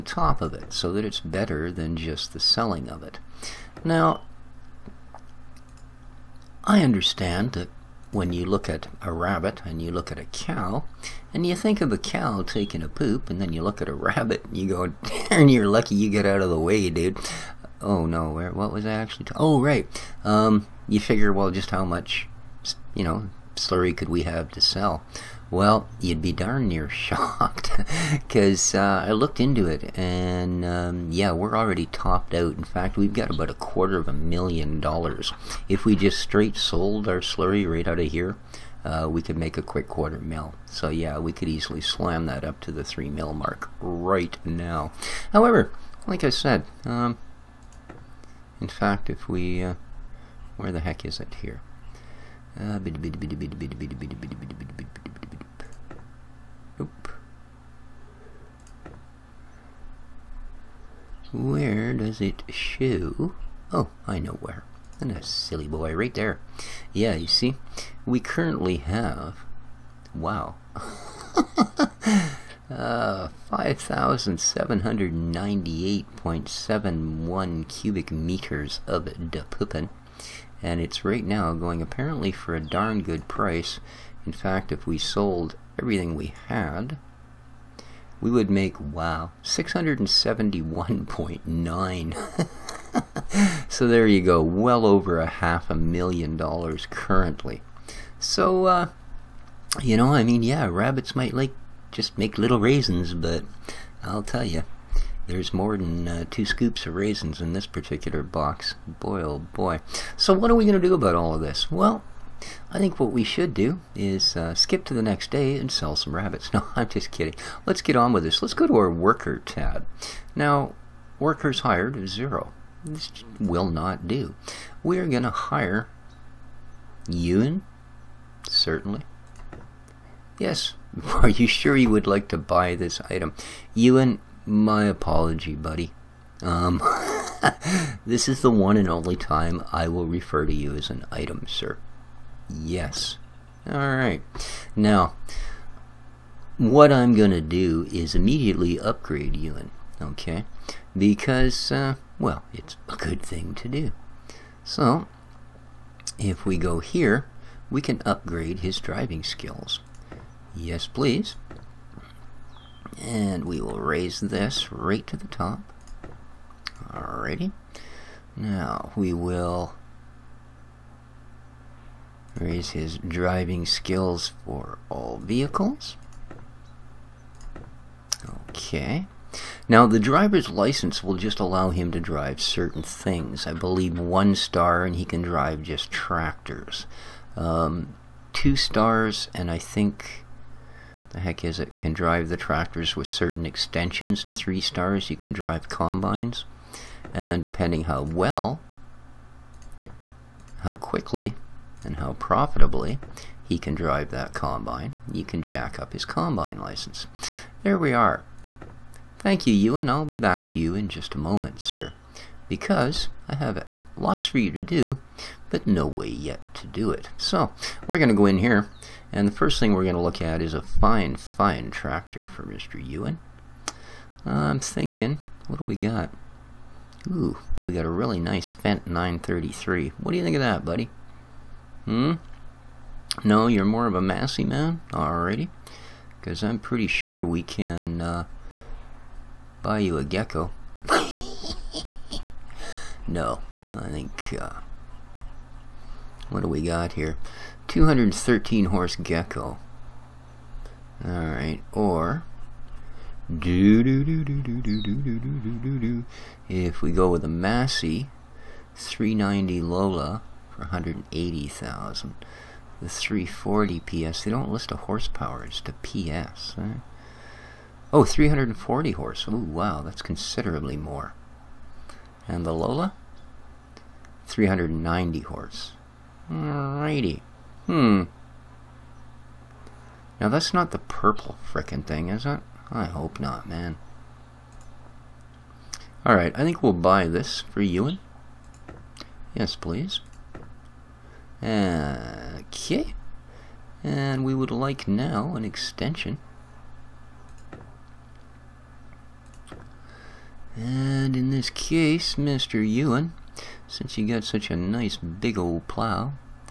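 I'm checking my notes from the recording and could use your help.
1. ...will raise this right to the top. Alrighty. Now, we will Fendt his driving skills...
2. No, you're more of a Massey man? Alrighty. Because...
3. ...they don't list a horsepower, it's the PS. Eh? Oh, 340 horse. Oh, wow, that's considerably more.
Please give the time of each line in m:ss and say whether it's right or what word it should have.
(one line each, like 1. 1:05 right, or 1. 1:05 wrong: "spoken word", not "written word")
1. 2:43 wrong: "Raise", not "Fendt"
2. 3:53 right
3. 4:24 right.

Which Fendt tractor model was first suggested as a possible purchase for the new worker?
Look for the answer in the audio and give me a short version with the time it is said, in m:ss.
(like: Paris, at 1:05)
Fendt 933, at 3:48.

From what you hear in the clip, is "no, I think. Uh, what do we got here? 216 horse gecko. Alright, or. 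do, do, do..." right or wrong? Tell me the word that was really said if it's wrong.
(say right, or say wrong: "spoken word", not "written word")
wrong: "213", not "216".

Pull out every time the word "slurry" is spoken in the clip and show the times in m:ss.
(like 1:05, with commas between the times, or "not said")
0:23, 0:37.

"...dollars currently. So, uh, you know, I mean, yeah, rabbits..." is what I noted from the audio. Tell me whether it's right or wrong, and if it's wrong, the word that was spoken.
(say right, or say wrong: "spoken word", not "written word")
right.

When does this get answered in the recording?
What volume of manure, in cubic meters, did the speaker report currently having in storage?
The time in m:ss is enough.
1:13.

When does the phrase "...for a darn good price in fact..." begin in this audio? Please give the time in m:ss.
1:22.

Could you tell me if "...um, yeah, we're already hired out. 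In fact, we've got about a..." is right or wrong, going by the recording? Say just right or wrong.
wrong.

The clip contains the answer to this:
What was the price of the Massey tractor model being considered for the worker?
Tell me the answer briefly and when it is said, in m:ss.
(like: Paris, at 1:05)
180,000, at 4:20.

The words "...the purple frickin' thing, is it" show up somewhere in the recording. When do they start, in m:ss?
4:40.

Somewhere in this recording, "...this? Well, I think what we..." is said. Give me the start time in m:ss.
1:51.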